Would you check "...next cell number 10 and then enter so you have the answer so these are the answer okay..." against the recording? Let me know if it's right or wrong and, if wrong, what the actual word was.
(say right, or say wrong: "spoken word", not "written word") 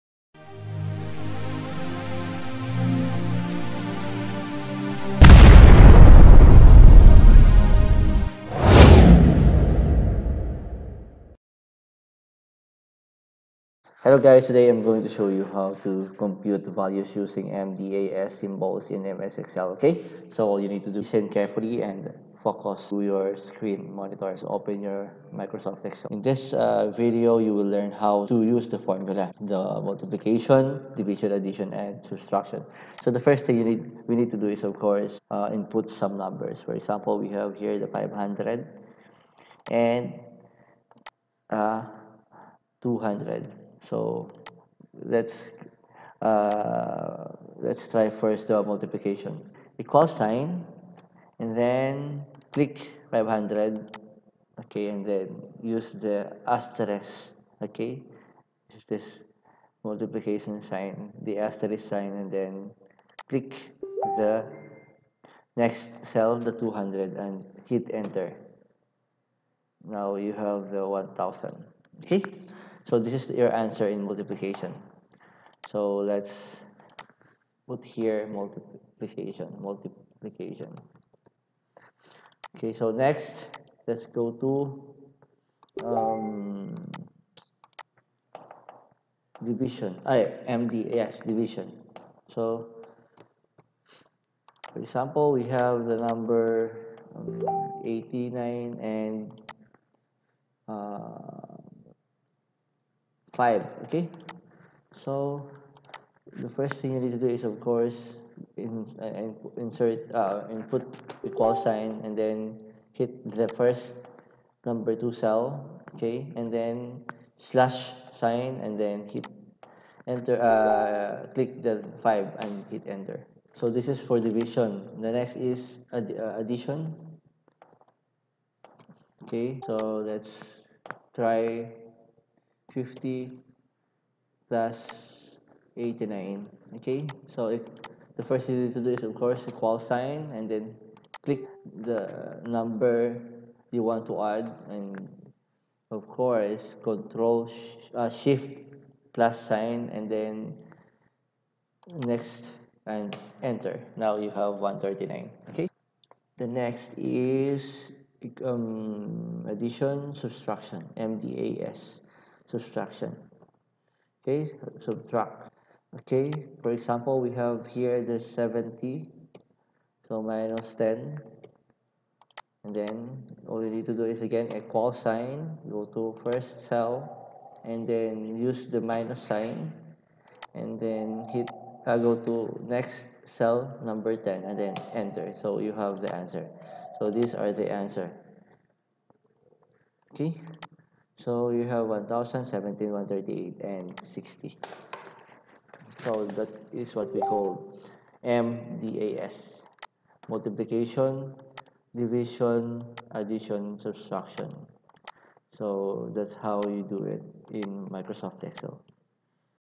right.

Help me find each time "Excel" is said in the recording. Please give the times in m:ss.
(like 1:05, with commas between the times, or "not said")
0:19, 0:25, 3:28.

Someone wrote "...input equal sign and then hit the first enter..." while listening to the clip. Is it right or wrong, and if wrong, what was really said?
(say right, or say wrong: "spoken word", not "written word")
wrong: "number", not "enter".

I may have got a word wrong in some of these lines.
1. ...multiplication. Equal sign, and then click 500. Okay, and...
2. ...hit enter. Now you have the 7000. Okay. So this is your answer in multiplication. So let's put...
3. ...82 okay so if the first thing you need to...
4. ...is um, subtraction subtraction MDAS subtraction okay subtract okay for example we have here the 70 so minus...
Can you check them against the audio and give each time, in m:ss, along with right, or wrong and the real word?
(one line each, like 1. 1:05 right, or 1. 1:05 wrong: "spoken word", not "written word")
1. 0:48 right
2. 1:07 wrong: "1000", not "7000"
3. 2:15 wrong: "89", not "82"
4. 2:36 wrong: "addition", not "subtraction".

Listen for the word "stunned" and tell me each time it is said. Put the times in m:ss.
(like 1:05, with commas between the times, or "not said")
not said.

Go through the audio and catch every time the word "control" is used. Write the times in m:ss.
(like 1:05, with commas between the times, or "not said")
2:26.